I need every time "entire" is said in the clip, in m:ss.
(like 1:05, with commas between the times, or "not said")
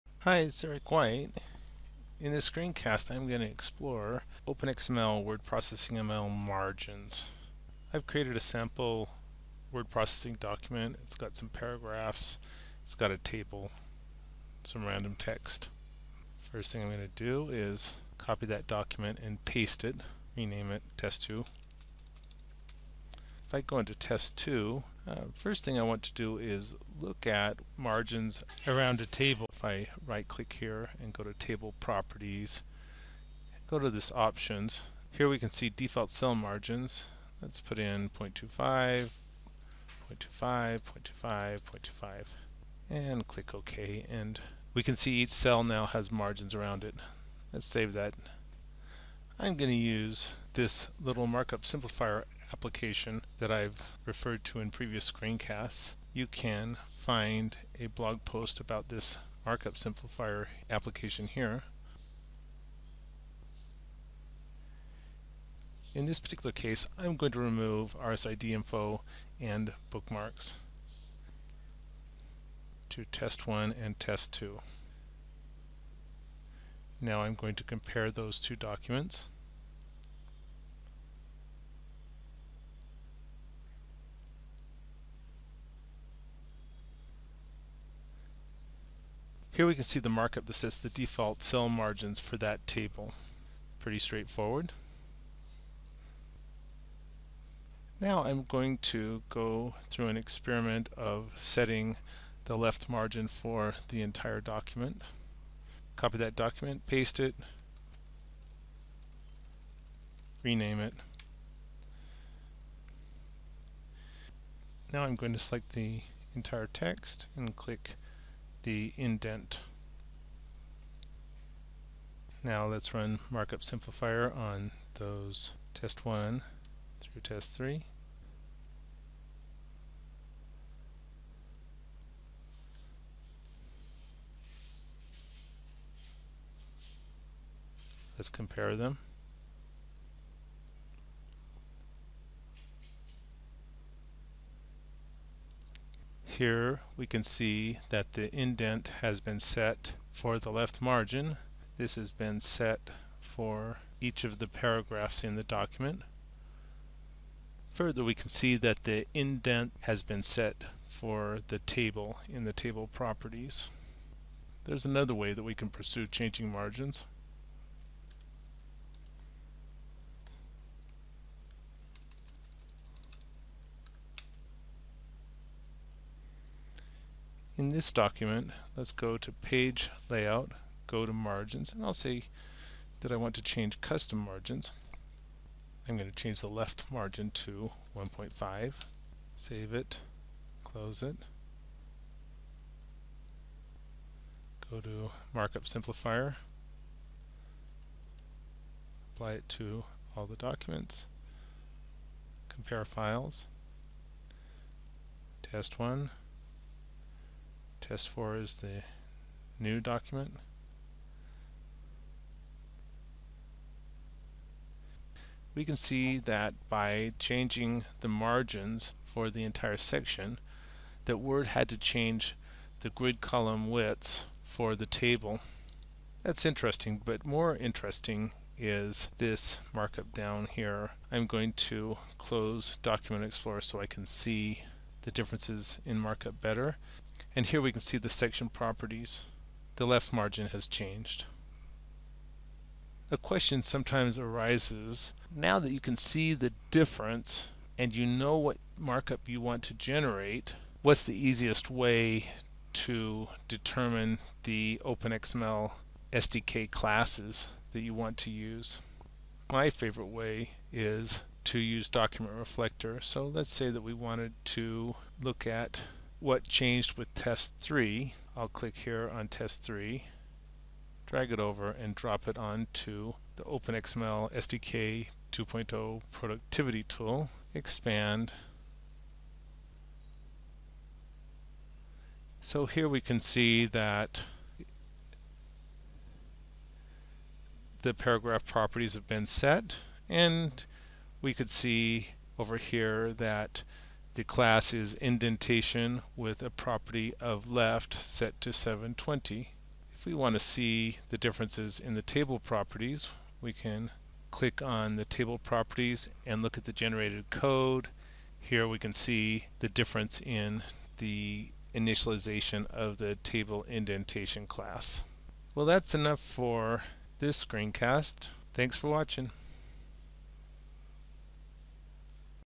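1:44, 1:56, 3:39.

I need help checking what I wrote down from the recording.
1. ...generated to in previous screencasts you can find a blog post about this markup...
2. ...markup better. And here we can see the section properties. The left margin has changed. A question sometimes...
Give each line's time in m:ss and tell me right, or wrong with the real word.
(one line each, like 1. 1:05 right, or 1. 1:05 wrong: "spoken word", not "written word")
1. 0:54 wrong: "referred", not "generated"
2. 3:55 right.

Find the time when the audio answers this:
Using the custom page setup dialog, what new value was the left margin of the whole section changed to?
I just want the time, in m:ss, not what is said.
3:07.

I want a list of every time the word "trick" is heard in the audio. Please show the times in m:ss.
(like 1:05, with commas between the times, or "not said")
not said.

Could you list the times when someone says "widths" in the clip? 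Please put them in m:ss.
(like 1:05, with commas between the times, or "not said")
3:43.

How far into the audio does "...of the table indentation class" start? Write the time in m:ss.
5:12.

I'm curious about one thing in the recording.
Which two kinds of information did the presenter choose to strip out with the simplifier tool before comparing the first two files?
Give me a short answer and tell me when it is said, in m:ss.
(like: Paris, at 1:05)
RSID info and bookmarks, at 1:07.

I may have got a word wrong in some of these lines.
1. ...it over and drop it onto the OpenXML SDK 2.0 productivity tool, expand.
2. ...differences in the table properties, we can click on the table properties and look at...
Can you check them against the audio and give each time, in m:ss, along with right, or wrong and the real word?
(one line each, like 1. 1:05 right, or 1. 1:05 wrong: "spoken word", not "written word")
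1. 4:31 right
2. 5:01 right.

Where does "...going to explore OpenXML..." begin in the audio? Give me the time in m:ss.
0:03.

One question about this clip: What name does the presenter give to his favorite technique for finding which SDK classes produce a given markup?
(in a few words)
document reflector.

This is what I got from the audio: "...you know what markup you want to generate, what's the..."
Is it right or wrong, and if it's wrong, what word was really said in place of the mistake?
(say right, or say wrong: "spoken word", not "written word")
right.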